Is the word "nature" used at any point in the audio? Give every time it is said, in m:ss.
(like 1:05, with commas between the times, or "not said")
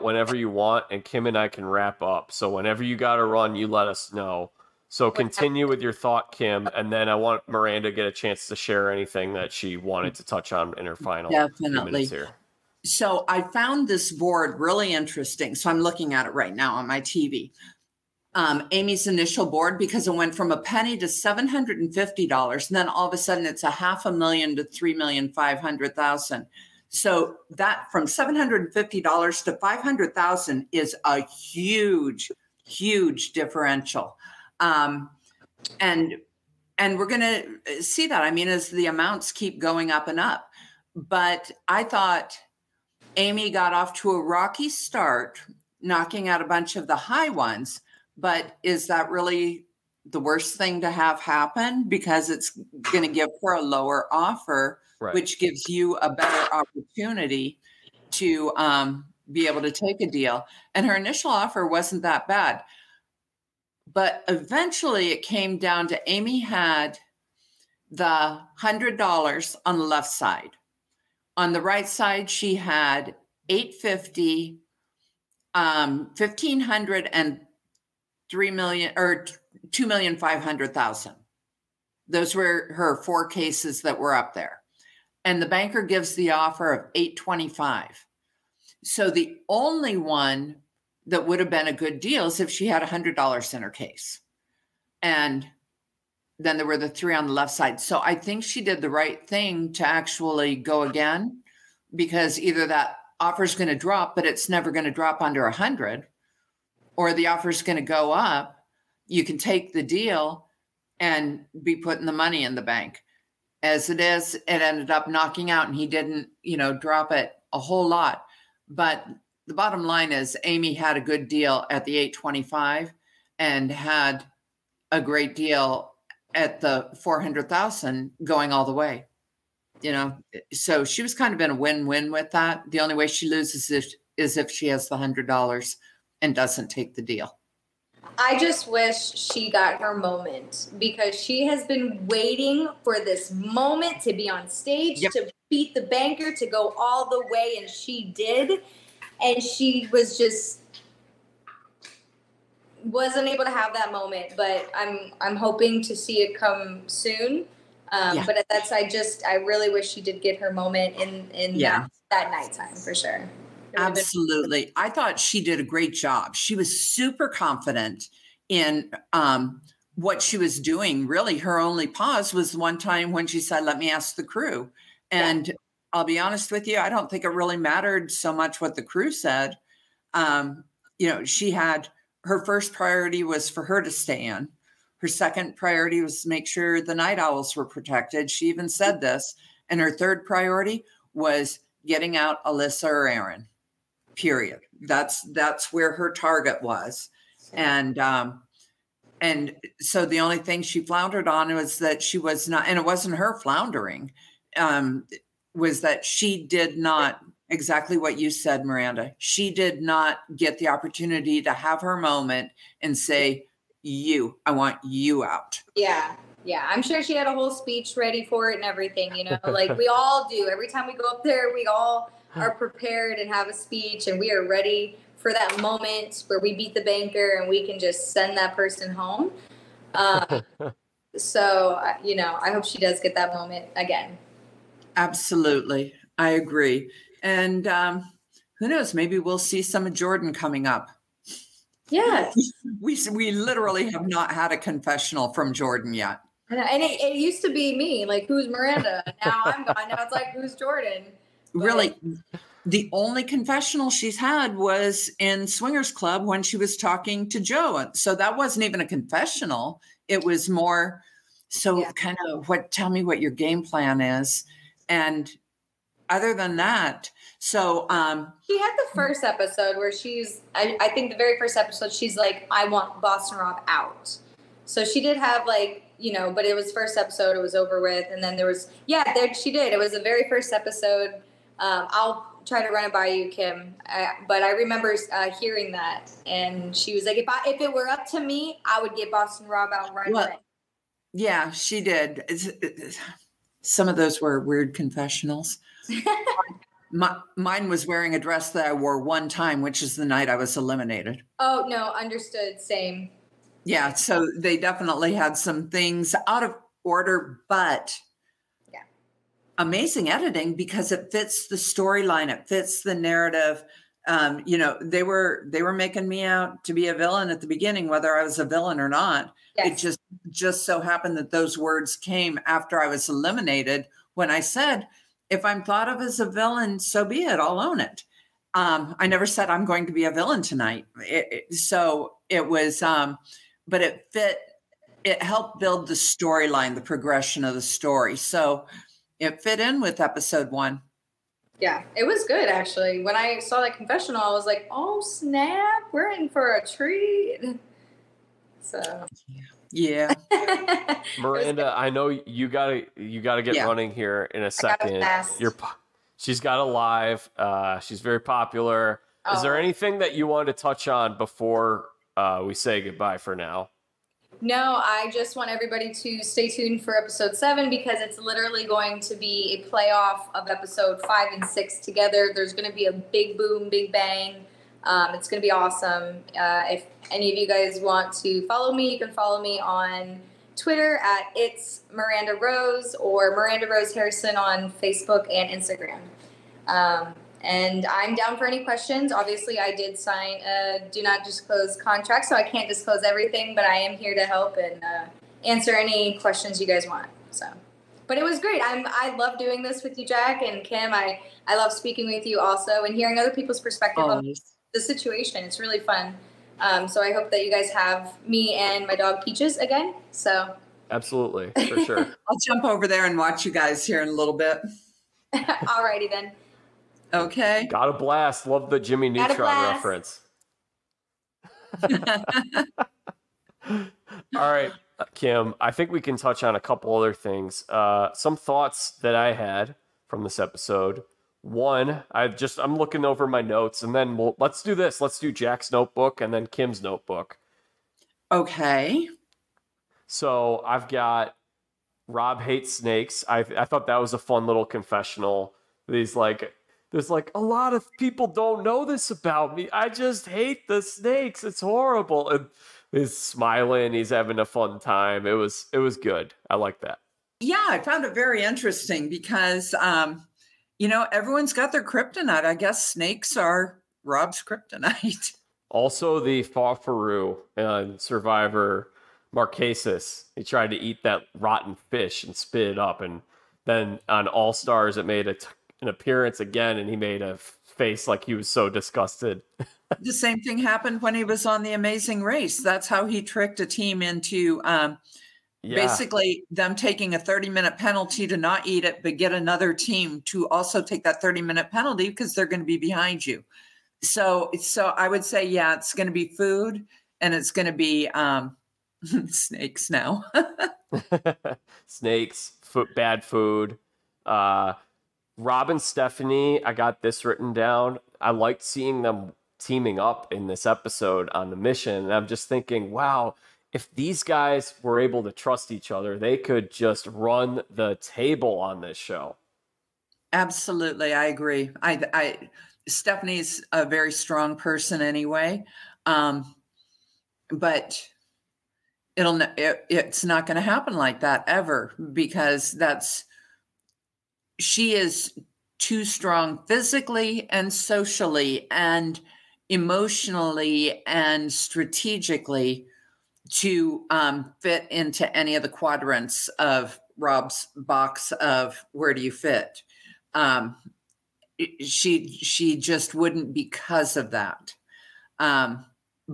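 not said.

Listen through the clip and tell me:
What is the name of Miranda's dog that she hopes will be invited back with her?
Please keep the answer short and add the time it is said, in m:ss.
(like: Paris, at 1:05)
Peaches, at 6:49.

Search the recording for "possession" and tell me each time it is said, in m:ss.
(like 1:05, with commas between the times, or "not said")
not said.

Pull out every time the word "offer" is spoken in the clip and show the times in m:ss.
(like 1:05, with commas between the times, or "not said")
0:54, 1:01, 1:26, 1:43, 1:47.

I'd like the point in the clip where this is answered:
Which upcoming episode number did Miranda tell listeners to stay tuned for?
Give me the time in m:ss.
6:06.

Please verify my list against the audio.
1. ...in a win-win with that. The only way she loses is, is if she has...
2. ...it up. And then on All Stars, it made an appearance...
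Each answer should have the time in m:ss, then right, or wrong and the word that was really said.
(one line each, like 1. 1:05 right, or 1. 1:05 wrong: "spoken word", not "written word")
1. 2:11 right
2. 7:52 right.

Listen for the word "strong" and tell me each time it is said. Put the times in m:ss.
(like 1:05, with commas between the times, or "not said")
8:44, 8:56.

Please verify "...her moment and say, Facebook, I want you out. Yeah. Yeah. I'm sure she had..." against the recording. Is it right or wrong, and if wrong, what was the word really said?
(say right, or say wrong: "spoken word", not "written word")
wrong: "You", not "Facebook".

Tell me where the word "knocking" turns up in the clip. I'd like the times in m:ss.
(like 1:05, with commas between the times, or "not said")
0:45, 1:55.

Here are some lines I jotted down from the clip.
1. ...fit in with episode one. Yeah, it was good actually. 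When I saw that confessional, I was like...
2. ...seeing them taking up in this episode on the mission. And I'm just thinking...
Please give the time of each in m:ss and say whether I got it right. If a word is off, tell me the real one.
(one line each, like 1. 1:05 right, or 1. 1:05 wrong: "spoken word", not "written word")
1. 5:39 right
2. 8:28 wrong: "teaming", not "taking".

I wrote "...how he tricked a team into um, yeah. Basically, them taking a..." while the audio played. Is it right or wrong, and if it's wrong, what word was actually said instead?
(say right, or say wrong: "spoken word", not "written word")
right.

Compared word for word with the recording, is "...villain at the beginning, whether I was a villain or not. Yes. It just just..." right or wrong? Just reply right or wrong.
right.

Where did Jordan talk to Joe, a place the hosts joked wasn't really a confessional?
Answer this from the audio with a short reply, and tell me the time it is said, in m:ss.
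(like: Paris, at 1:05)
Swingers Club, at 4:15.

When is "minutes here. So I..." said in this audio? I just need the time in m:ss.
0:11.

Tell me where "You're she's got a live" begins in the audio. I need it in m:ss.
5:55.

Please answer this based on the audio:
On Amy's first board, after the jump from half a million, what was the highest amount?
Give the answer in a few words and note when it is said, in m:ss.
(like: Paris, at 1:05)
3,500,000, at 0:24.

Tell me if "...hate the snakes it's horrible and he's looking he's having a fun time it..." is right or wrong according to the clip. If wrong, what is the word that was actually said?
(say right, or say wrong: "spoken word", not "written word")
wrong: "smiling", not "looking".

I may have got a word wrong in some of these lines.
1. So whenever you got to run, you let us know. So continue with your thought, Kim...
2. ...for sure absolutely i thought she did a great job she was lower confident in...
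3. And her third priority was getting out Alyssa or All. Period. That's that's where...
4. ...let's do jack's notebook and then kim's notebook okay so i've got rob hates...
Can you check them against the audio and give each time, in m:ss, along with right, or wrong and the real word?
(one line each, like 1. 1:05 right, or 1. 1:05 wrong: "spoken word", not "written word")
1. 0:02 right
2. 2:42 wrong: "super", not "lower"
3. 3:09 wrong: "Aron", not "All"
4. 7:15 right.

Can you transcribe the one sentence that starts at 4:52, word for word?
It's, it's, some of those were weird confessionals.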